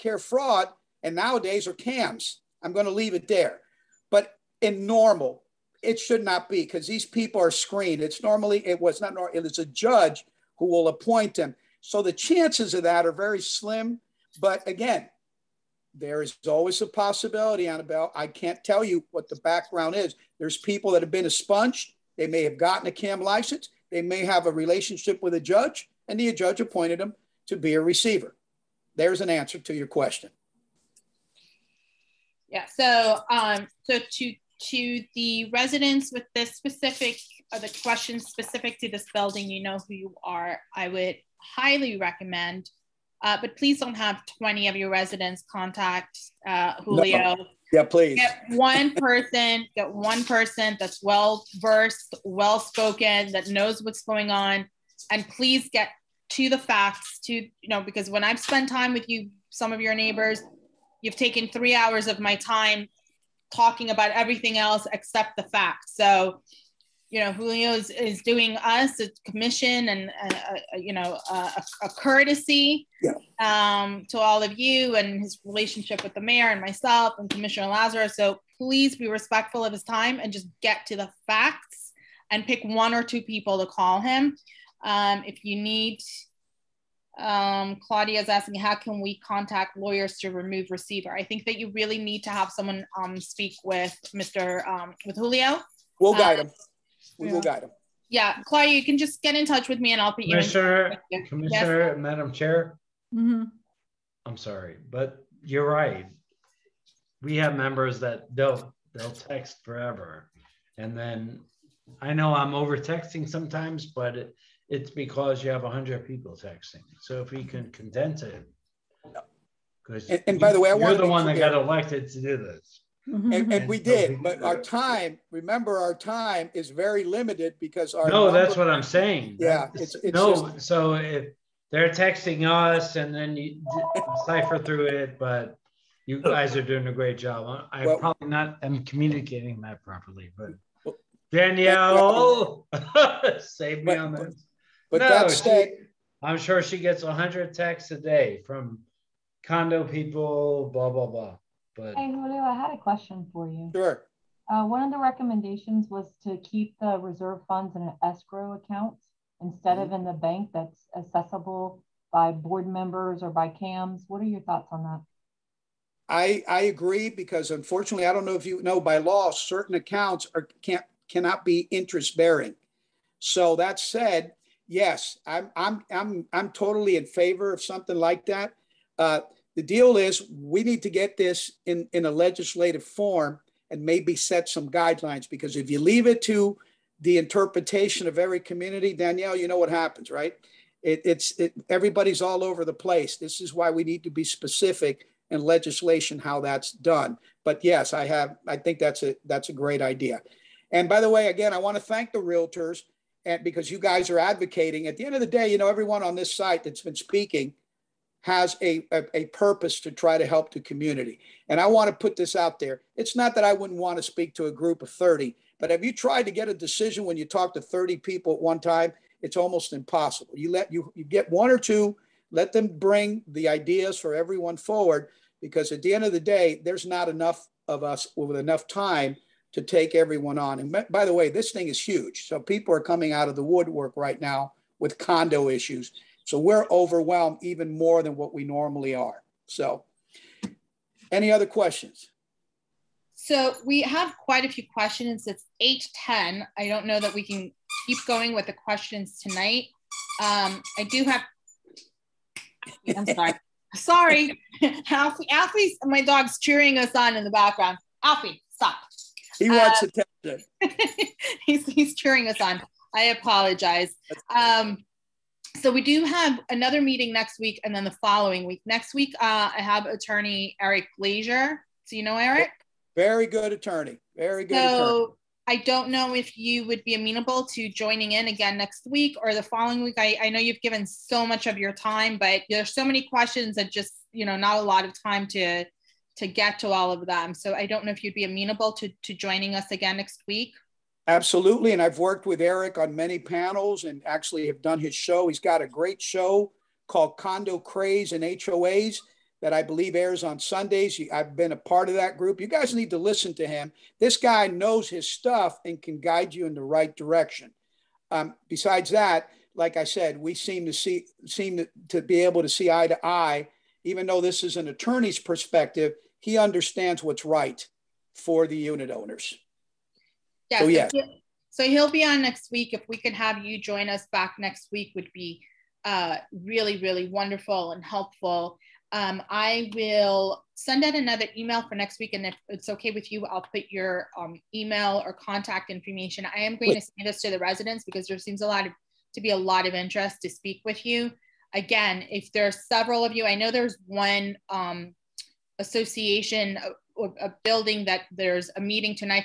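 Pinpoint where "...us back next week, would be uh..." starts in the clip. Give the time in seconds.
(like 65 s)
323 s.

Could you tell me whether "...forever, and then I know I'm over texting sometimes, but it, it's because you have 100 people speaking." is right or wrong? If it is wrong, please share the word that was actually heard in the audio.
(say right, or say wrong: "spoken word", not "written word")
wrong: "texting", not "speaking".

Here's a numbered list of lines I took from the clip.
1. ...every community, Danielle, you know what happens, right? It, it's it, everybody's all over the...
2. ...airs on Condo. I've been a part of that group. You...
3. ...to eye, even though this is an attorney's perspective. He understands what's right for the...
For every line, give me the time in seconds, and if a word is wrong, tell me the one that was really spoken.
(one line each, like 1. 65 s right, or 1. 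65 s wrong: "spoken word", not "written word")
1. 188 s right
2. 299 s wrong: "Sundays", not "Condo"
3. 312 s right.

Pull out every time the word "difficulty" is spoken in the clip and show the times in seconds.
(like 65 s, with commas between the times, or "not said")
not said.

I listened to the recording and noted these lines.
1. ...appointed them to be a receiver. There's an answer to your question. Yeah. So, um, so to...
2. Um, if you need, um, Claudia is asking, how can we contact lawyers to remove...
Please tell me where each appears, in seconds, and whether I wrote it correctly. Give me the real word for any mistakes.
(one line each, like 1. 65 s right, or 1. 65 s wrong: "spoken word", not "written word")
1. 26 s right
2. 84 s right.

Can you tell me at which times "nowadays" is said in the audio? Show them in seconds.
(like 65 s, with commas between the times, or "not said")
1 s.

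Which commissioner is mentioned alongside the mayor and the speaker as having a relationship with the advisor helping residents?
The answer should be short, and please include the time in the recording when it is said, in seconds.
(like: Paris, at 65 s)
Commissioner Lazarow, at 77 s.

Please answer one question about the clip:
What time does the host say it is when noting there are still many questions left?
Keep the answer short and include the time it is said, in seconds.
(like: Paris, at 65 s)
8:10, at 245 s.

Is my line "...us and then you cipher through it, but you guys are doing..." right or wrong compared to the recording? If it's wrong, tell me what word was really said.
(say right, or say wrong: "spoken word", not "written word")
right.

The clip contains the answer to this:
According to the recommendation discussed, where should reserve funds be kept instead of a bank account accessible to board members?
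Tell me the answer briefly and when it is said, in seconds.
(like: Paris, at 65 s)
An escrow account, at 158 s.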